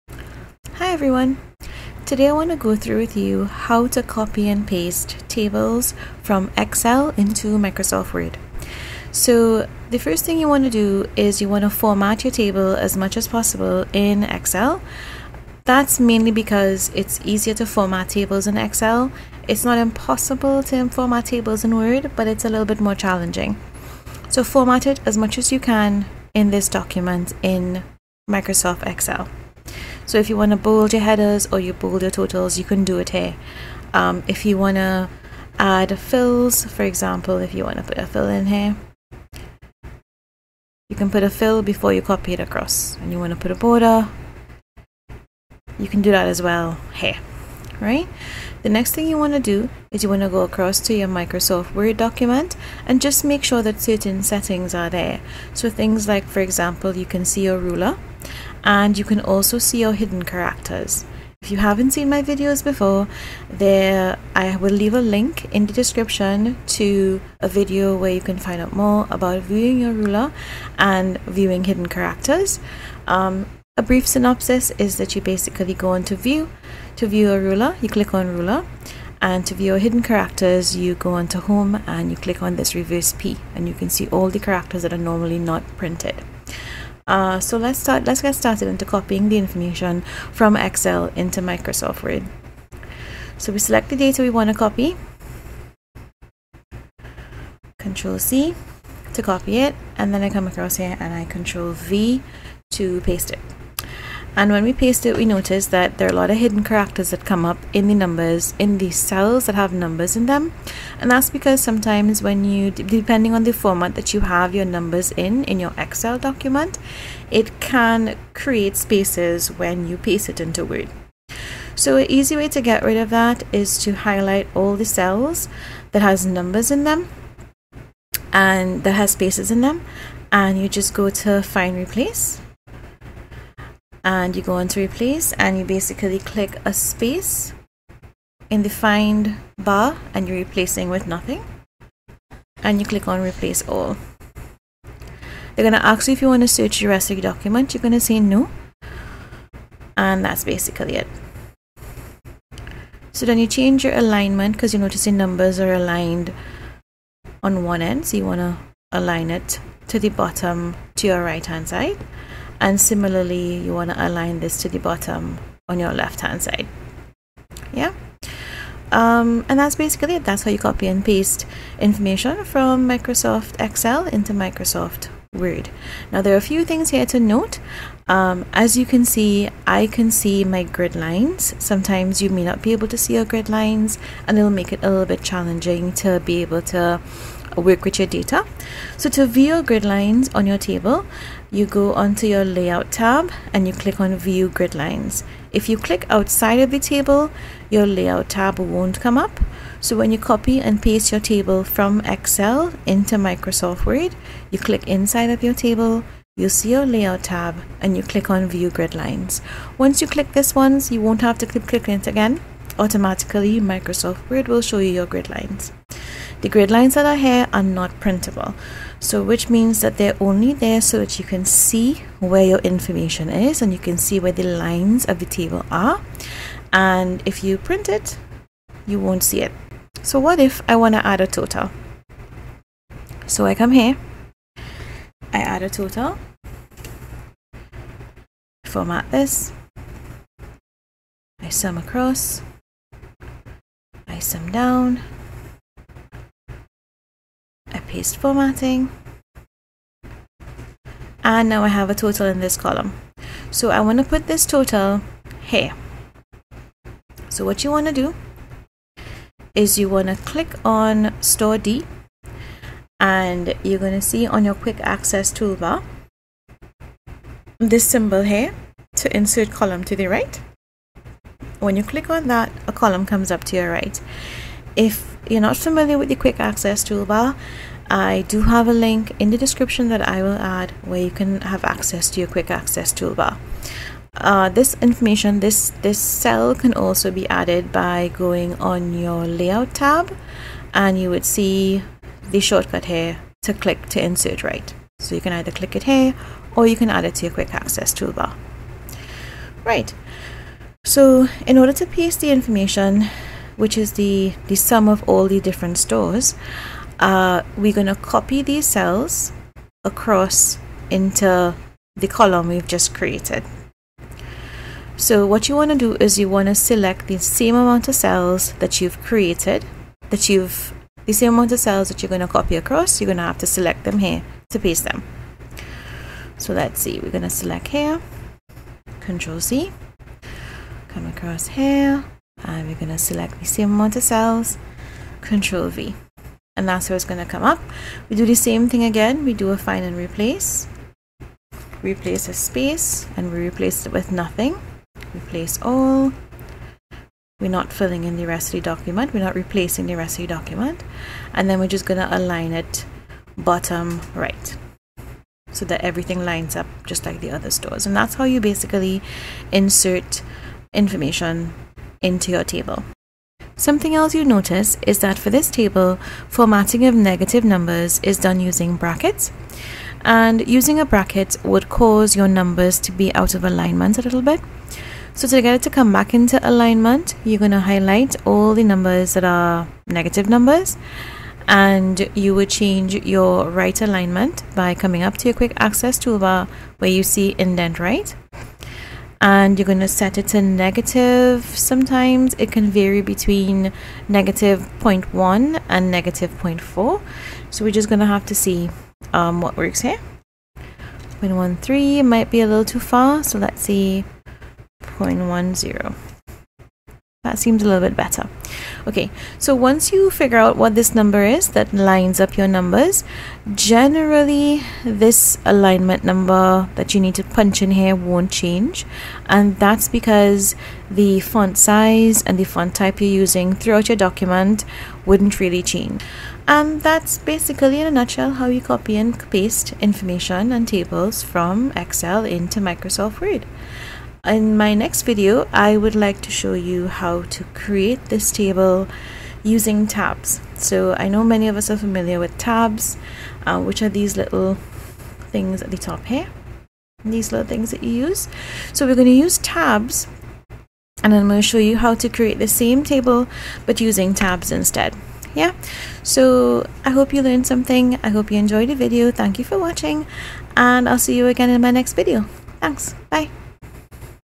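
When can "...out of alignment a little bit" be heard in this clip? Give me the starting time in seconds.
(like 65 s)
373 s.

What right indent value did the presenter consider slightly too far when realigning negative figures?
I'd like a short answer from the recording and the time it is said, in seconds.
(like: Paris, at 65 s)
-0.13, at 401 s.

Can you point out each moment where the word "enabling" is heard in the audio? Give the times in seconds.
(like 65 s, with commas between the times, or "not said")
not said.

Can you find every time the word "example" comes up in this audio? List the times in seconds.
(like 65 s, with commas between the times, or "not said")
36 s, 56 s.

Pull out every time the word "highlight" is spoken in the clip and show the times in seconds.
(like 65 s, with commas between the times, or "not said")
123 s, 377 s.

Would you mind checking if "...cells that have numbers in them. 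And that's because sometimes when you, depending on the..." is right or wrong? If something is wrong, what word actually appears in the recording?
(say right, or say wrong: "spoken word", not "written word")
right.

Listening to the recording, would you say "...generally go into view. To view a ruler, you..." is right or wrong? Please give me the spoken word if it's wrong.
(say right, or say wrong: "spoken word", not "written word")
wrong: "basically", not "generally".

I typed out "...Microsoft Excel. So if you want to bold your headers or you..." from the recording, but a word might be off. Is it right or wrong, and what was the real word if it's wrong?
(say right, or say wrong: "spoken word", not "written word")
right.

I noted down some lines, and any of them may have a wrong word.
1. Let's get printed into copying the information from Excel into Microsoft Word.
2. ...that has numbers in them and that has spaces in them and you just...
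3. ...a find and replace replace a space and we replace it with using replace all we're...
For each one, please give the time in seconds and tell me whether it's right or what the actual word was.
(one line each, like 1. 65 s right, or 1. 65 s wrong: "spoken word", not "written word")
1. 88 s wrong: "started", not "printed"
2. 125 s right
3. 339 s wrong: "nothing", not "using".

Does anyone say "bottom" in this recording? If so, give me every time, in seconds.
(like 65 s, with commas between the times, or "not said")
160 s, 164 s, 353 s.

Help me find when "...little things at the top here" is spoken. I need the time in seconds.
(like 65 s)
444 s.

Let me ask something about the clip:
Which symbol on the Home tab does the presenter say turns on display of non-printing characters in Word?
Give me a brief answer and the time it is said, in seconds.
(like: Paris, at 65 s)
reverse P, at 82 s.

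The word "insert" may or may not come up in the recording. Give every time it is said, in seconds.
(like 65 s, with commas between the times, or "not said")
269 s, 294 s, 359 s.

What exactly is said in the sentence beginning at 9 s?
So the first thing you want to do is you want to format your table as much as possible in Excel.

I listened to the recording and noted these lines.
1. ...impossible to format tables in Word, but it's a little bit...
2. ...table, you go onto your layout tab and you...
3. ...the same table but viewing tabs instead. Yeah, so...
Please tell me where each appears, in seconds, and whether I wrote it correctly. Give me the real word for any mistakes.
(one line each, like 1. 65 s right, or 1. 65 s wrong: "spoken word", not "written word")
1. 19 s right
2. 190 s right
3. 452 s wrong: "using", not "viewing".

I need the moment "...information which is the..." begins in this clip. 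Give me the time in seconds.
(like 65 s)
302 s.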